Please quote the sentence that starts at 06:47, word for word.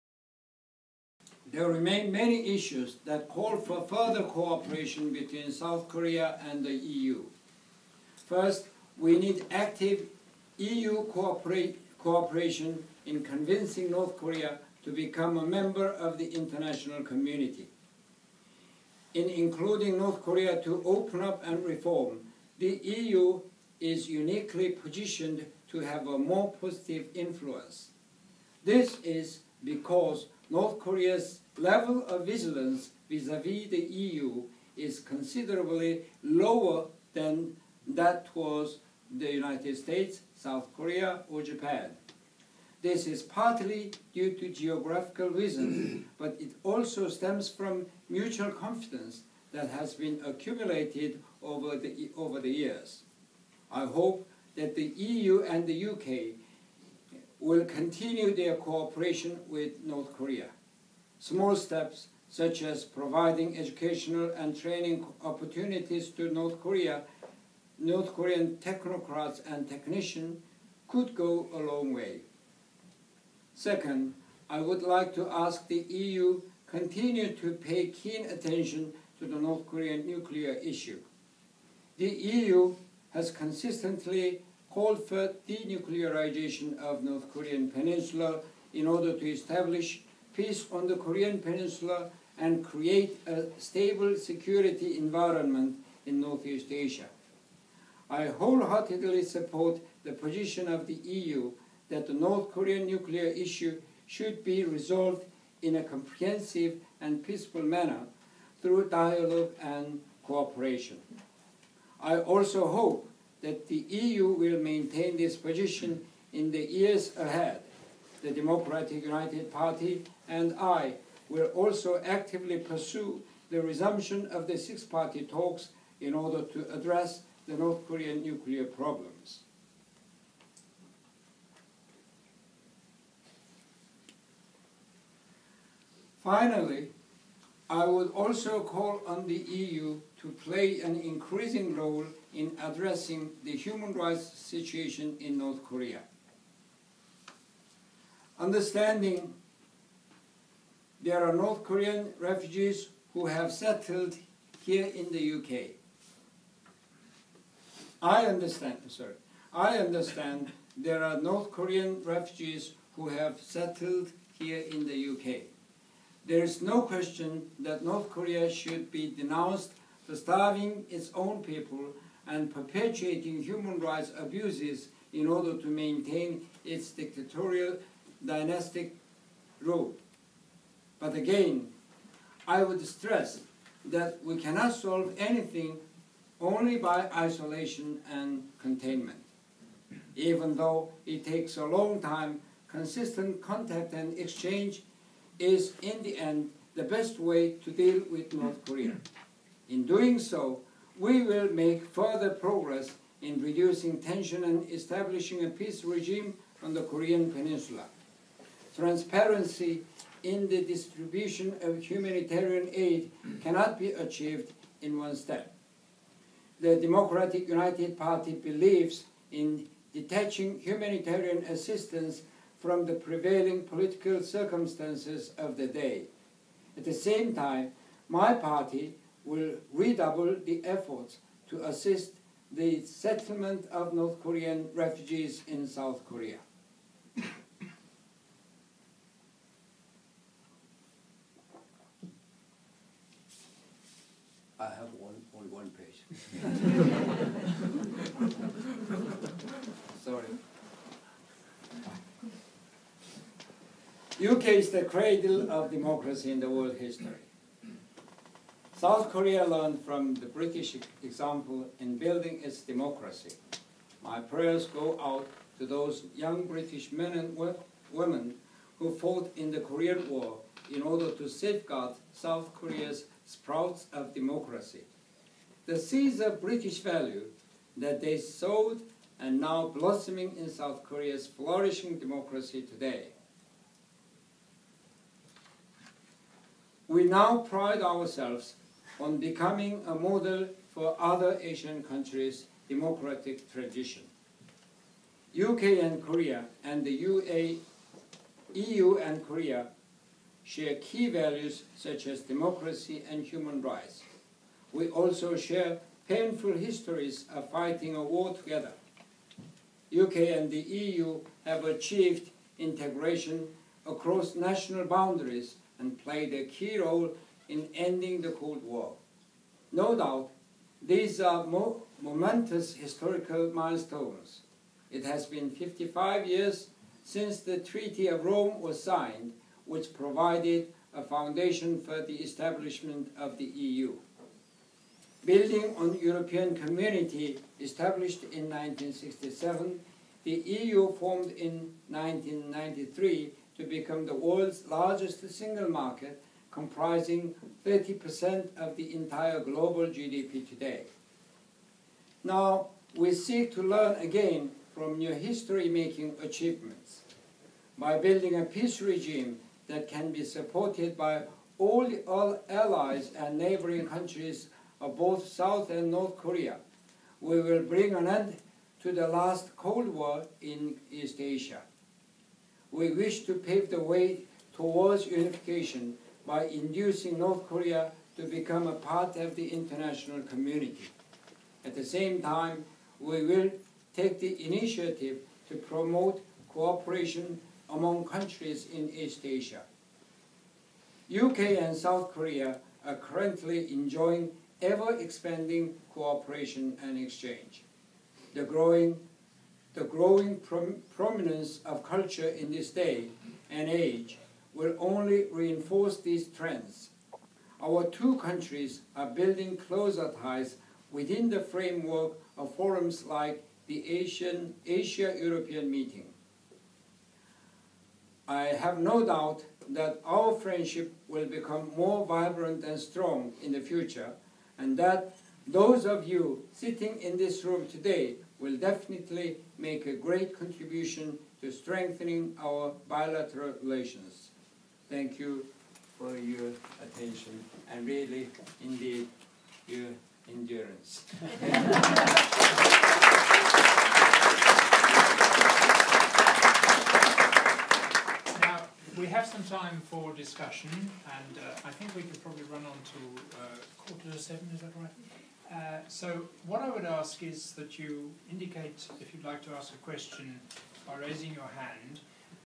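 Our two countries are building closer ties within the framework of forums like the Asian Asia-European meeting.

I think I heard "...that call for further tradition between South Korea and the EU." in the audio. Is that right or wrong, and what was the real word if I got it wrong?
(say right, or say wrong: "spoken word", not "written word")
wrong: "cooperation", not "tradition".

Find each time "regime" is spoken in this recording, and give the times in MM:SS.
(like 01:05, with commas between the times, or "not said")
03:25, 05:58.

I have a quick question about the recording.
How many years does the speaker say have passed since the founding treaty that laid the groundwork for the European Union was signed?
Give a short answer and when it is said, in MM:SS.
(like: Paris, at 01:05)
55, at 05:25.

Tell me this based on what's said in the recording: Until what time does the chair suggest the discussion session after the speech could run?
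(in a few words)
quarter to seven.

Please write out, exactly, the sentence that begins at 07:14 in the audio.
Thank you for your attention and really, indeed, your endurance.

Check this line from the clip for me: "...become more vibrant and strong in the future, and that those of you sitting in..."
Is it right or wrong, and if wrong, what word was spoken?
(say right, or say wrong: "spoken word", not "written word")
right.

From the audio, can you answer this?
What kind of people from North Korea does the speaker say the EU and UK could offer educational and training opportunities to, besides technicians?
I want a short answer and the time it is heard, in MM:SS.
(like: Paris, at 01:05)
technocrats, at 01:08.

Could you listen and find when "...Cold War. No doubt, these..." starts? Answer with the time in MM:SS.
05:18.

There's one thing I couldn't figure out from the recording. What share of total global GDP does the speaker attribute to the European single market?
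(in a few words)
30%.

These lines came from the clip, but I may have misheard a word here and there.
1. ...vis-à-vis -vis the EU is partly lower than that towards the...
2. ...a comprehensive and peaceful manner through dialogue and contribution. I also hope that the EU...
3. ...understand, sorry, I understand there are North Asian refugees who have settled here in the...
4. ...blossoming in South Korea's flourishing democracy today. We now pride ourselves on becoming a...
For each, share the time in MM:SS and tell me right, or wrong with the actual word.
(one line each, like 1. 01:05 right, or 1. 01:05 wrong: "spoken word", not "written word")
1. 00:33 wrong: "considerably", not "partly"
2. 01:45 wrong: "cooperation", not "contribution"
3. 02:38 wrong: "Korean", not "Asian"
4. 04:39 right.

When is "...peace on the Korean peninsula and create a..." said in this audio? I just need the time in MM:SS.
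01:30.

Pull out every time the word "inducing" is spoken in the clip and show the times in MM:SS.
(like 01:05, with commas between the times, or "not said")
06:16.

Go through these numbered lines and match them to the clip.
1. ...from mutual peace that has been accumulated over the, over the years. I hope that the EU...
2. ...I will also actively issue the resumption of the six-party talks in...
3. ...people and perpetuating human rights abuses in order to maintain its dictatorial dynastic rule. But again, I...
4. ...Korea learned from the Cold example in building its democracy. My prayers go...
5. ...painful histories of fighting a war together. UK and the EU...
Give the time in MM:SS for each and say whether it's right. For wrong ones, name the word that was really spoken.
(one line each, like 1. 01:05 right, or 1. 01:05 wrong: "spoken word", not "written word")
1. 00:47 wrong: "confidence", not "peace"
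2. 02:00 wrong: "pursue", not "issue"
3. 02:51 right
4. 04:19 wrong: "British", not "Cold"
5. 05:06 right.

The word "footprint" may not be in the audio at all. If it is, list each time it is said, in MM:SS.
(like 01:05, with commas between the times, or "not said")
not said.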